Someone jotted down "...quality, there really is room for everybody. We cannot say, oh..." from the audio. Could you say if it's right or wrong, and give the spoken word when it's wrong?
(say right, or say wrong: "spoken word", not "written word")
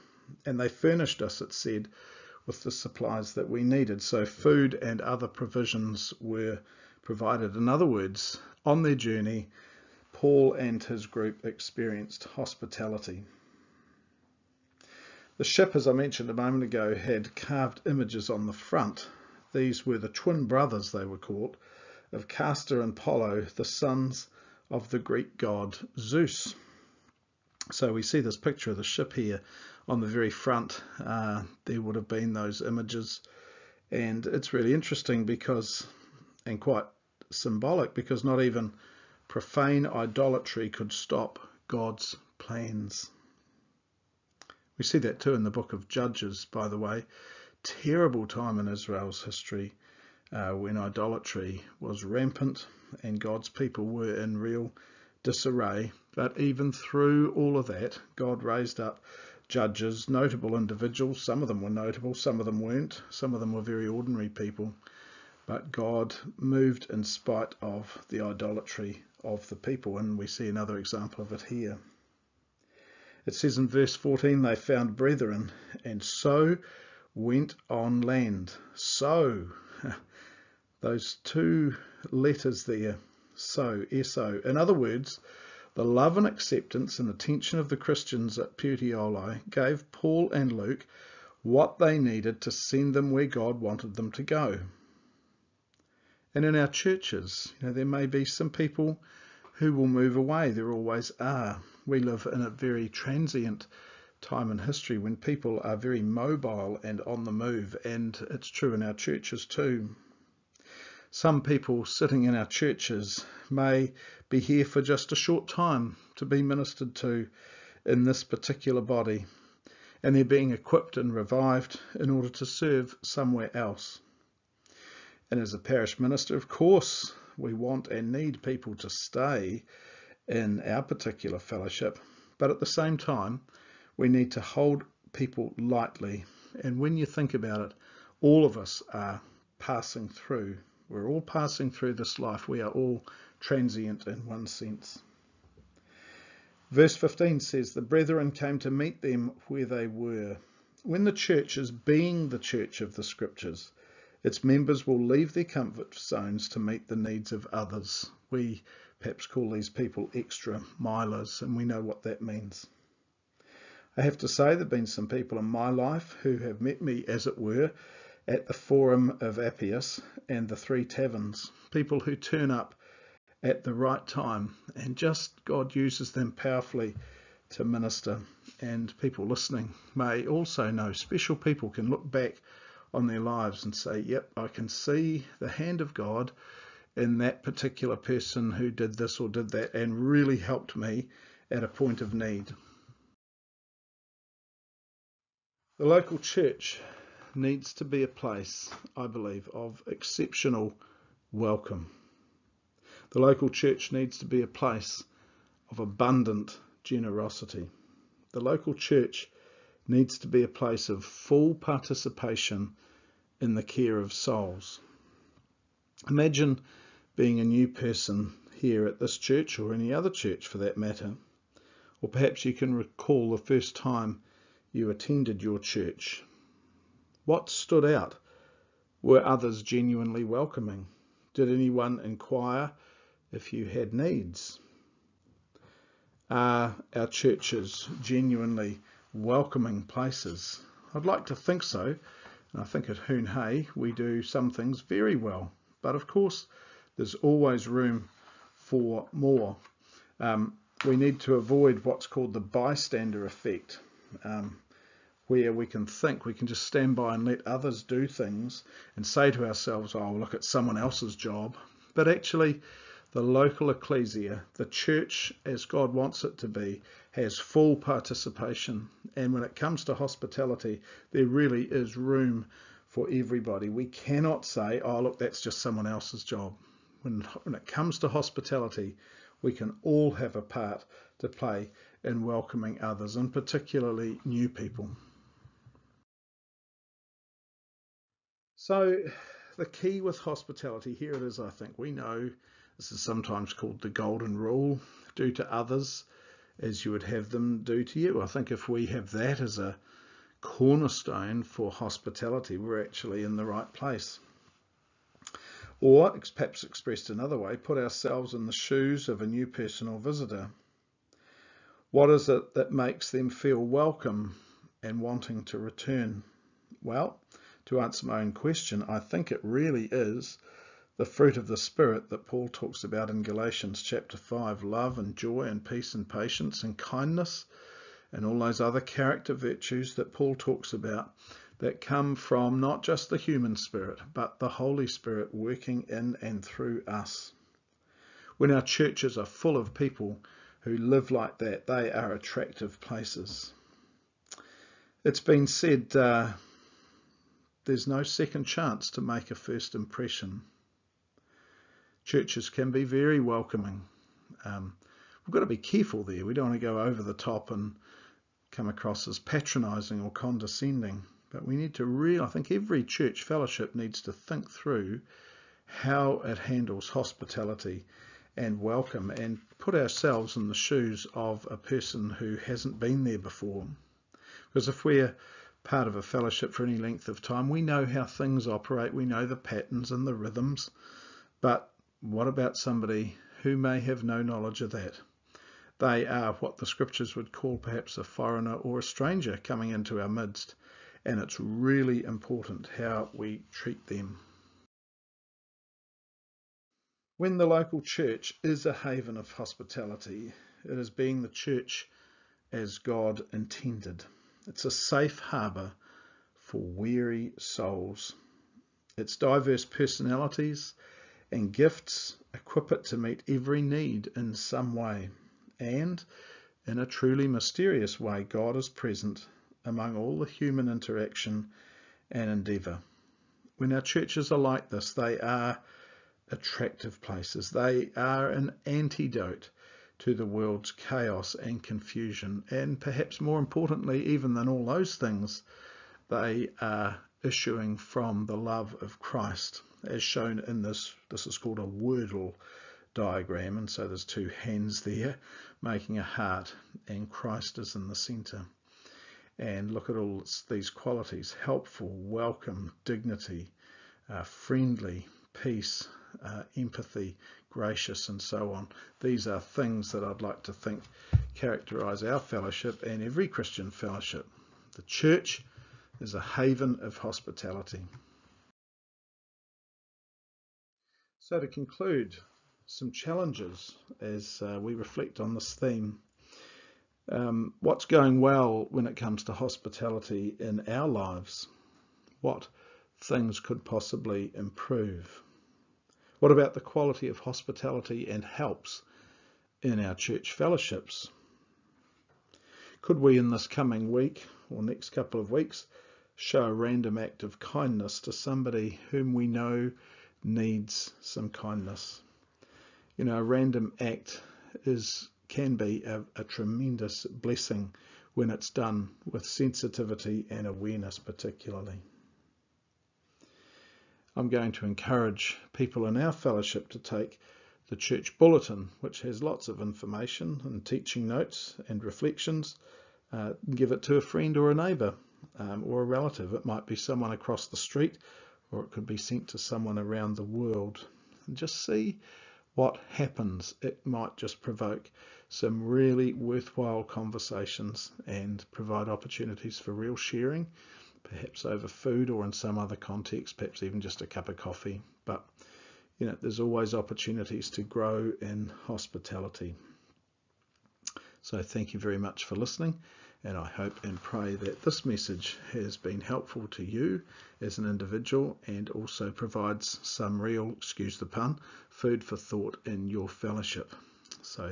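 wrong: "hospitality", not "quality".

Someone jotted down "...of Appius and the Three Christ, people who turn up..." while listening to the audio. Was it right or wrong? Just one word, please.
wrong.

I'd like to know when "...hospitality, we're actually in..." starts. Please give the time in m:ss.
5:01.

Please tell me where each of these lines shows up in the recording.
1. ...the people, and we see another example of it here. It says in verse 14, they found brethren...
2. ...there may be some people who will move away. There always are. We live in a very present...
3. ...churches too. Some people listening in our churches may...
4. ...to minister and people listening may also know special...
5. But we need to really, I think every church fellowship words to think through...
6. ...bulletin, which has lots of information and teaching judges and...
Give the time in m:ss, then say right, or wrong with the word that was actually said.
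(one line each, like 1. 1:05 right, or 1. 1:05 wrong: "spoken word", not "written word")
1. 1:09 right
2. 1:37 wrong: "transient", not "present"
3. 1:48 wrong: "sitting", not "listening"
4. 2:57 right
5. 6:01 wrong: "needs", not "words"
6. 8:38 wrong: "notes", not "judges".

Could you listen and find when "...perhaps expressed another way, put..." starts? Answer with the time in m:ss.
5:06.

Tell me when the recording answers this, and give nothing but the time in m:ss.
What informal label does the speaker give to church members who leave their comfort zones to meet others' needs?
2:40.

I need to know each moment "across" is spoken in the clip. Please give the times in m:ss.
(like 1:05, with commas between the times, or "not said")
5:58, 8:47.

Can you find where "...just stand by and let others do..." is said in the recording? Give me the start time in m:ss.
4:16.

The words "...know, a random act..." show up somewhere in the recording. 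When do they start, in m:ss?
8:23.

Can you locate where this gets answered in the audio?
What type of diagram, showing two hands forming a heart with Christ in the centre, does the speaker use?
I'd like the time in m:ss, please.
7:21.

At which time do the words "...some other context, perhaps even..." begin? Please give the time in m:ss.
9:02.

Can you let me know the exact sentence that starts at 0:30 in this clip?
Uh, there would have been those images.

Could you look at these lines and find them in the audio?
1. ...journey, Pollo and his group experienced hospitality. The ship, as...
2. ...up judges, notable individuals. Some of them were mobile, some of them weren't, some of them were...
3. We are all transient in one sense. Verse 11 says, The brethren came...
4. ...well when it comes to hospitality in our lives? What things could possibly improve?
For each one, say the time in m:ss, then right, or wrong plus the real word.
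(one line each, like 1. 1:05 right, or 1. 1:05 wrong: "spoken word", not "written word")
1. 0:08 wrong: "Paul", not "Pollo"
2. 0:58 wrong: "notable", not "mobile"
3. 2:22 wrong: "15", not "11"
4. 7:58 right.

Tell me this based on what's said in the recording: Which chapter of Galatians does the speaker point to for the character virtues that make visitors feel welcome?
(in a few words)
Chapter 5.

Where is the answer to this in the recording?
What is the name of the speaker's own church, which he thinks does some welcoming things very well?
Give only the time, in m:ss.
4:02.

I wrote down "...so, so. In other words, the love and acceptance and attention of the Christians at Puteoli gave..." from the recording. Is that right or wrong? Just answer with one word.
right.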